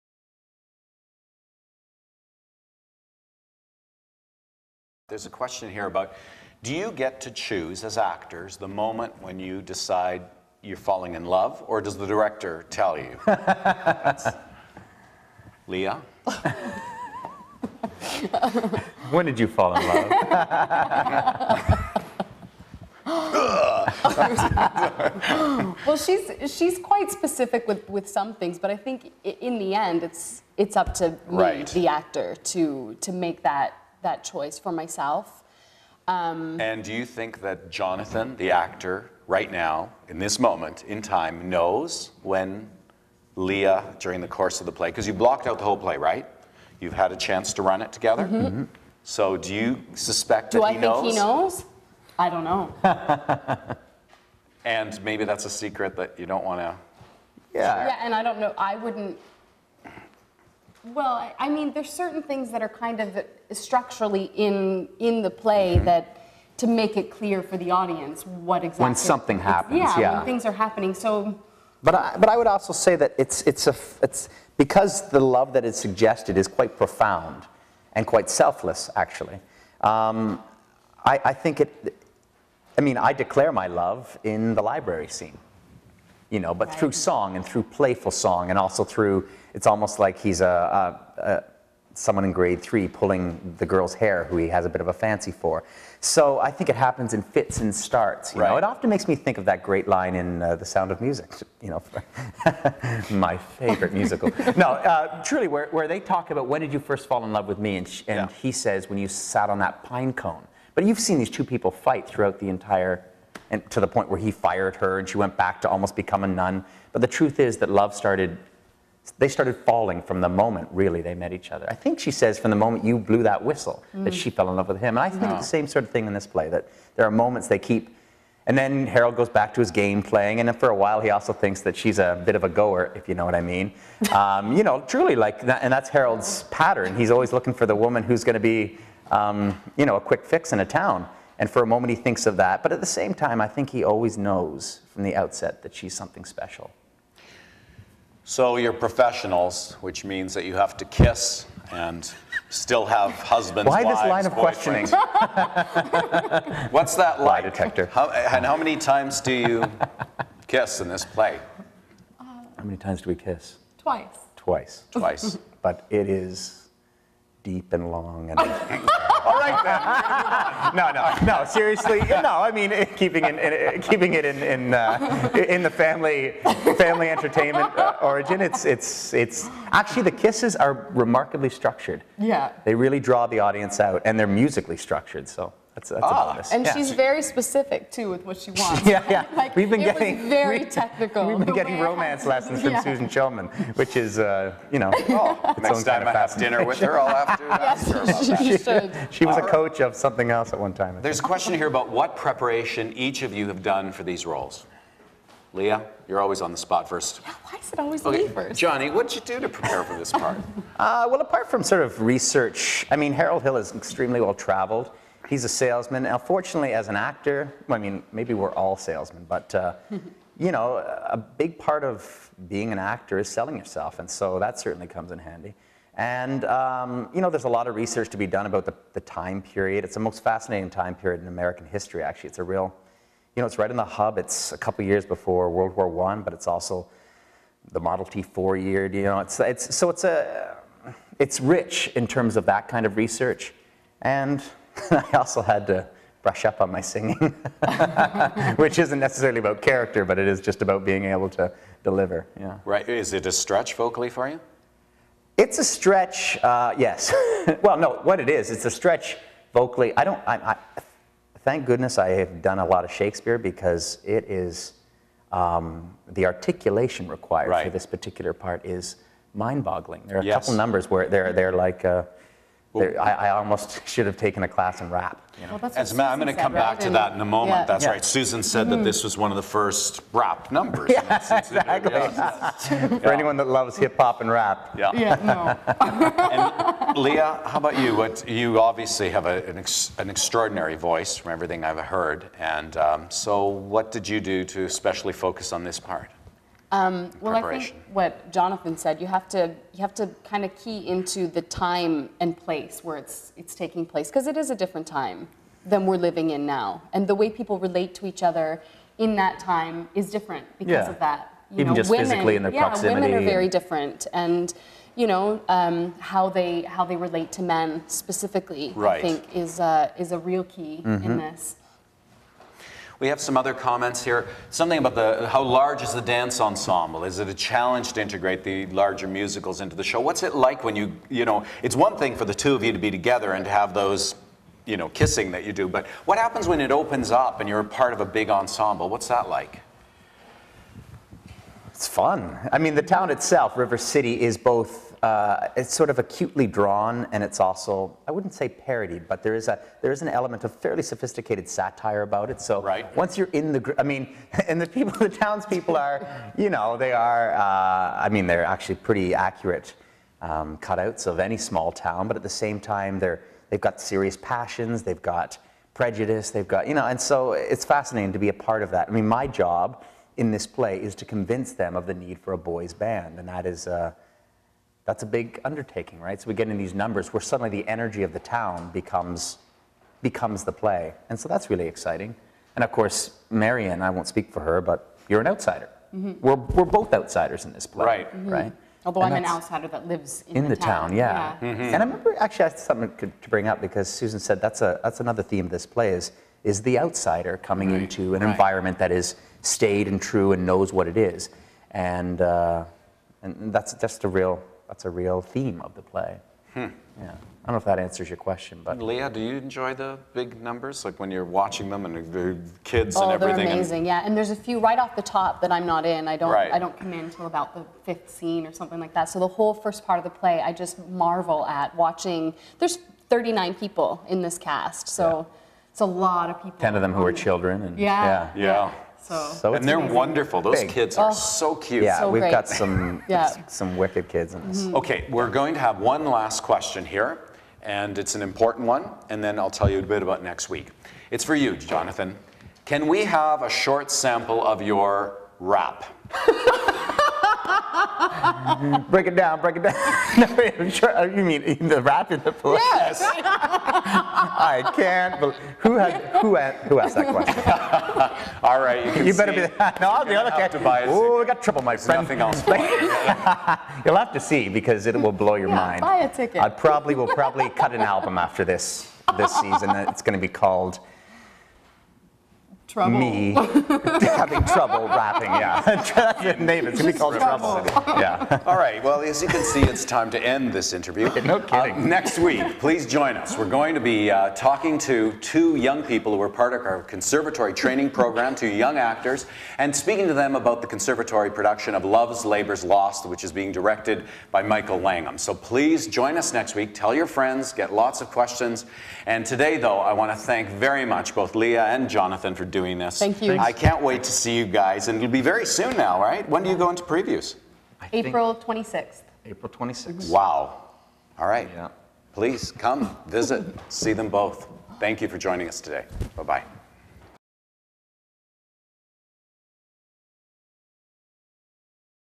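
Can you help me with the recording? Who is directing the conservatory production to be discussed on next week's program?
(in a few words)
Michael Langham.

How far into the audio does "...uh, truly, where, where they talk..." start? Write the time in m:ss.
1:44.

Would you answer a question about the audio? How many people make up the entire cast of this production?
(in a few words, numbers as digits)
39.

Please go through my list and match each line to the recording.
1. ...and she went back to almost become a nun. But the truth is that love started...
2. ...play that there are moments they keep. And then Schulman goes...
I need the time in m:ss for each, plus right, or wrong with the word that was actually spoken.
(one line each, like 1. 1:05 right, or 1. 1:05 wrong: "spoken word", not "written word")
1. 1:54 right
2. 2:06 wrong: "Harold", not "Schulman".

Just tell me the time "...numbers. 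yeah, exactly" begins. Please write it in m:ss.
4:40.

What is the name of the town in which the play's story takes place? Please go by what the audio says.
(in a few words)
River City.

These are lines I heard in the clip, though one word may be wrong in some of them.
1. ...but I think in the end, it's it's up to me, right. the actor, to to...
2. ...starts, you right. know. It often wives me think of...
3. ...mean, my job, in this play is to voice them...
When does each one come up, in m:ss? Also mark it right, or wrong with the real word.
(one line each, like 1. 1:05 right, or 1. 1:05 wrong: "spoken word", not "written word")
1. 0:28 right
2. 1:37 wrong: "makes", not "wives"
3. 6:08 wrong: "convince", not "voice".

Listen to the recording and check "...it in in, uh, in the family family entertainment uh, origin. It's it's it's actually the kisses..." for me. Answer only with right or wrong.
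right.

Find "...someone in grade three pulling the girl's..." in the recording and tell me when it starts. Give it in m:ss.
1:31.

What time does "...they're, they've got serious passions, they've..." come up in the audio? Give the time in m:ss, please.
6:02.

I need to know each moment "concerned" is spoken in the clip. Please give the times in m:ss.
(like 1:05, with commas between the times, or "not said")
not said.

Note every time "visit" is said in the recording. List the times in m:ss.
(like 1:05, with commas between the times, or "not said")
8:33.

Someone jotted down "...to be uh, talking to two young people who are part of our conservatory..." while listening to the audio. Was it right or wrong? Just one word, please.
right.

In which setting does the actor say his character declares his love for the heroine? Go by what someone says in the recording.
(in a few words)
The library scene.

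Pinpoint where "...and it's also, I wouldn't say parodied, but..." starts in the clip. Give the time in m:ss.
5:47.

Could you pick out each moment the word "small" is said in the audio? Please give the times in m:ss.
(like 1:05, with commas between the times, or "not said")
6:01.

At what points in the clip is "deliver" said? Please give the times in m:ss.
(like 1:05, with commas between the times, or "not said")
4:11.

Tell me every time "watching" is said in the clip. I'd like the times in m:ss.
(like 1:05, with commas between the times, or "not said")
6:51, 7:01.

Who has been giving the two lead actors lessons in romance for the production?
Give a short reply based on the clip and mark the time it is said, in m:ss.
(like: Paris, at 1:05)
Susan Schulman, at 3:12.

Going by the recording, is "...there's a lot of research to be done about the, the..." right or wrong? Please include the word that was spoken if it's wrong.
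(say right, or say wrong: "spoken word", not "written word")
right.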